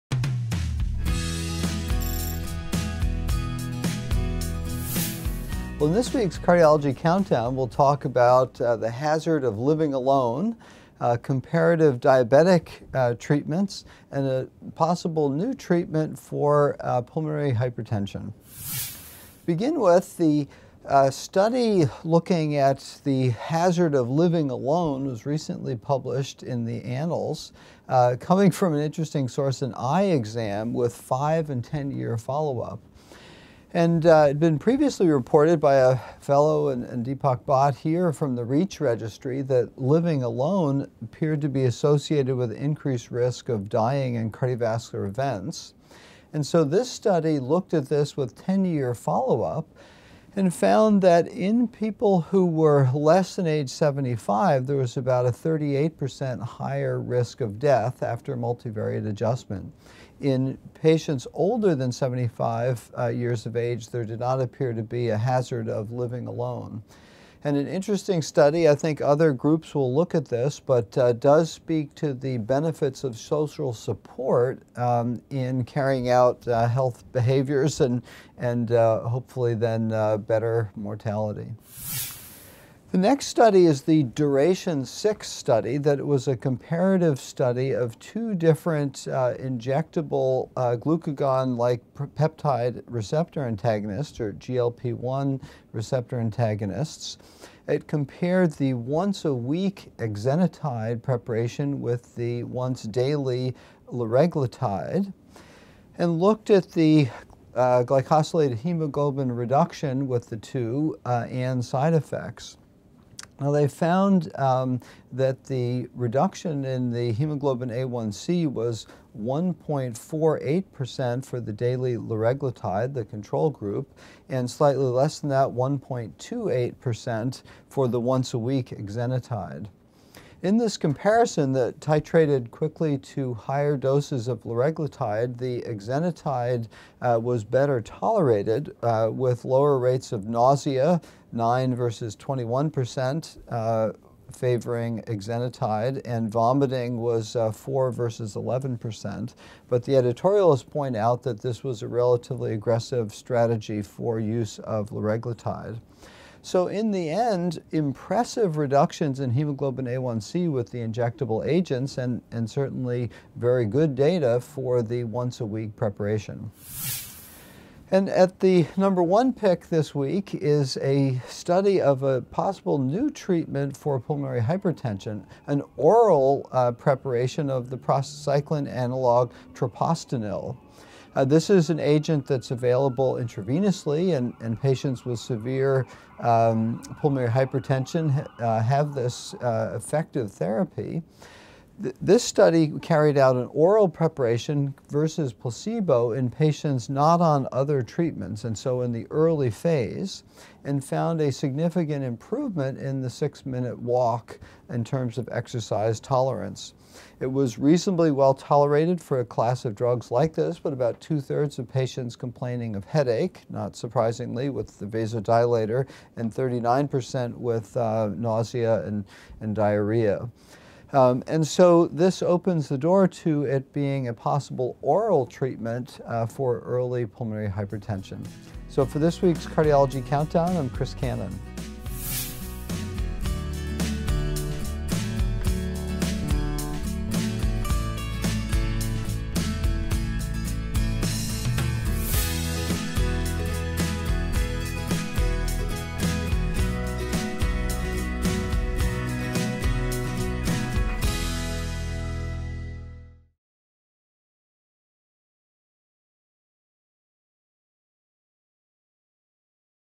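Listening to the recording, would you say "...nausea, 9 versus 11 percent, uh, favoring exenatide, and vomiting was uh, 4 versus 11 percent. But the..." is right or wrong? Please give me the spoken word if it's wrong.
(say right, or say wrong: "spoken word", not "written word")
wrong: "21", not "11".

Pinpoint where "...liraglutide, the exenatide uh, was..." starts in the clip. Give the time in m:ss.
2:14.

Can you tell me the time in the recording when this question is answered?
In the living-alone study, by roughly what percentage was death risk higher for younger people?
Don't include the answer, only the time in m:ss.
0:55.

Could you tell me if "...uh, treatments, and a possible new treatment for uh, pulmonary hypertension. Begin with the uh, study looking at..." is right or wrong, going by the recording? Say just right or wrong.
right.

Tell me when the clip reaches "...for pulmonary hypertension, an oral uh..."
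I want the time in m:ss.
2:53.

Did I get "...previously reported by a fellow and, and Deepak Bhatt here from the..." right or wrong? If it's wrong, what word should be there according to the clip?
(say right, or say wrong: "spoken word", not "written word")
right.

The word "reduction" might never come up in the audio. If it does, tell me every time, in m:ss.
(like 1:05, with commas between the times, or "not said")
1:49, 1:55, 2:38.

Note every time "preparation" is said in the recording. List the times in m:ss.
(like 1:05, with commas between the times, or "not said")
1:41, 2:45, 2:56, 3:13.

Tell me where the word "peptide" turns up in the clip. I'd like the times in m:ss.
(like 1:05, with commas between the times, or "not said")
1:31.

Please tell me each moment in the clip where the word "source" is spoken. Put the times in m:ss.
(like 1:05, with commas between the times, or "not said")
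0:29.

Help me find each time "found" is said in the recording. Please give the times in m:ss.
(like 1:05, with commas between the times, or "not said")
0:50, 1:53, 3:20.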